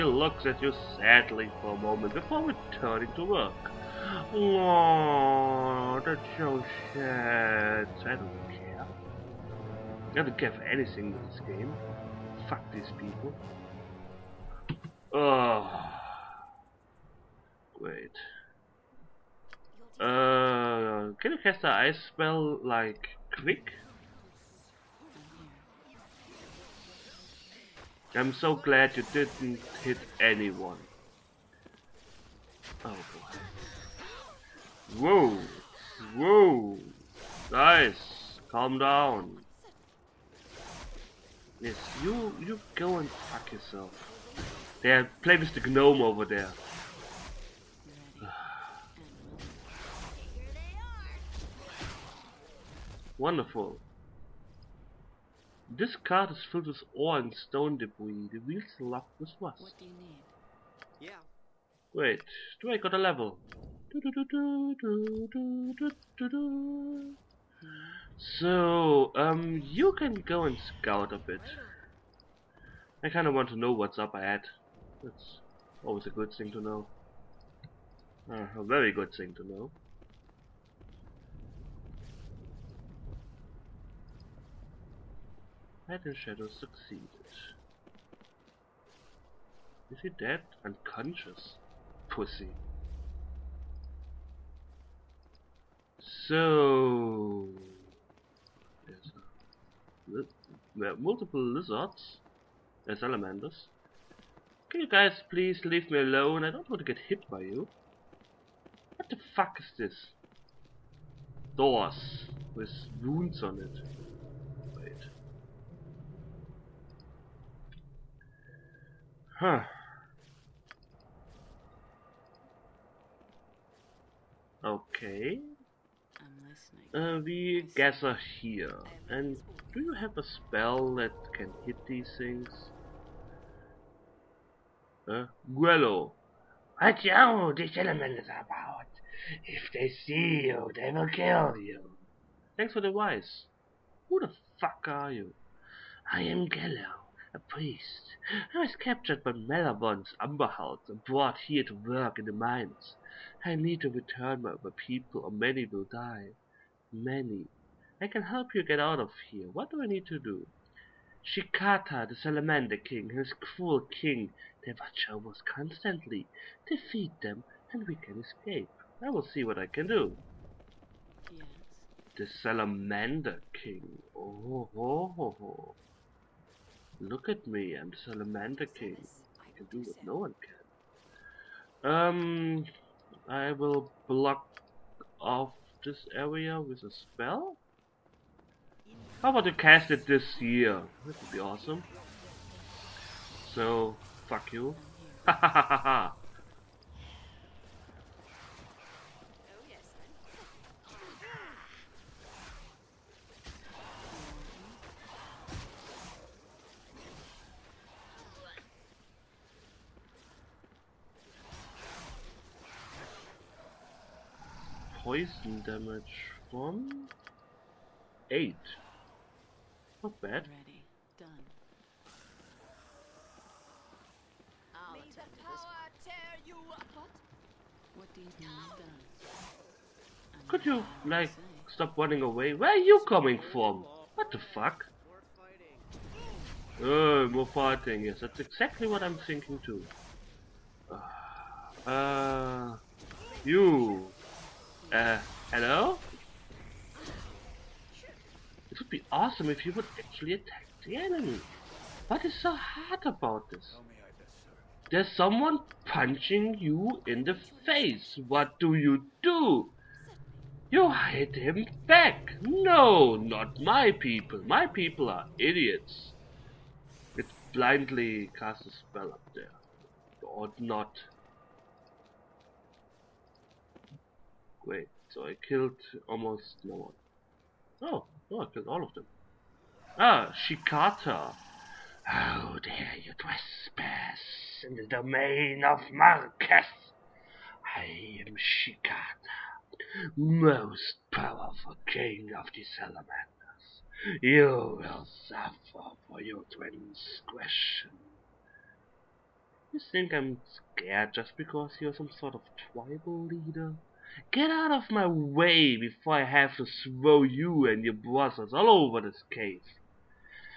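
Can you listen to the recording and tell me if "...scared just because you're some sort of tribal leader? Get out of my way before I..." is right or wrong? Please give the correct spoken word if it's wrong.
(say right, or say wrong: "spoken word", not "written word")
right.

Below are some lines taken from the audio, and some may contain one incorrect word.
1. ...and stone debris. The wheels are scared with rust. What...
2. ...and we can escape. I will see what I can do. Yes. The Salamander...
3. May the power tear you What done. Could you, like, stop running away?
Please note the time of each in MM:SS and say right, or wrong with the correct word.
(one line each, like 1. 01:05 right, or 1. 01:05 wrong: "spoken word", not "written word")
1. 00:57 wrong: "locked", not "scared"
2. 02:47 right
3. 03:44 right.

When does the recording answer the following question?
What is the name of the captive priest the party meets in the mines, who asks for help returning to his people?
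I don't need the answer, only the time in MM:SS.
02:26.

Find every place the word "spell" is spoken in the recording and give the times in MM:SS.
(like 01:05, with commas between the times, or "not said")
00:22, 02:10, 03:06, 04:28.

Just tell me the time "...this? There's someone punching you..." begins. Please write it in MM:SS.
04:13.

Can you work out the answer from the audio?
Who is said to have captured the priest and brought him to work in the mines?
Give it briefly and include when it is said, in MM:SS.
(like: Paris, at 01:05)
Malavon's Umberhouse, at 02:29.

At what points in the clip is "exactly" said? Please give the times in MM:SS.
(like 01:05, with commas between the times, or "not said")
03:58.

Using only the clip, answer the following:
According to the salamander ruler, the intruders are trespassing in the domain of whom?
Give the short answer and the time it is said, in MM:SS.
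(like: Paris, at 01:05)
Marketh, at 04:45.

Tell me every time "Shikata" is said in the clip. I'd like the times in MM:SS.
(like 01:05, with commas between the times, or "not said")
02:41, 04:40, 04:48.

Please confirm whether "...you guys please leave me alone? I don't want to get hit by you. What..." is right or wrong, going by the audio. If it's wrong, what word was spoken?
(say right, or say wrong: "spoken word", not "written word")
right.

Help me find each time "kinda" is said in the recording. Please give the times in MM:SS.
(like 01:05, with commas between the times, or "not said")
01:13.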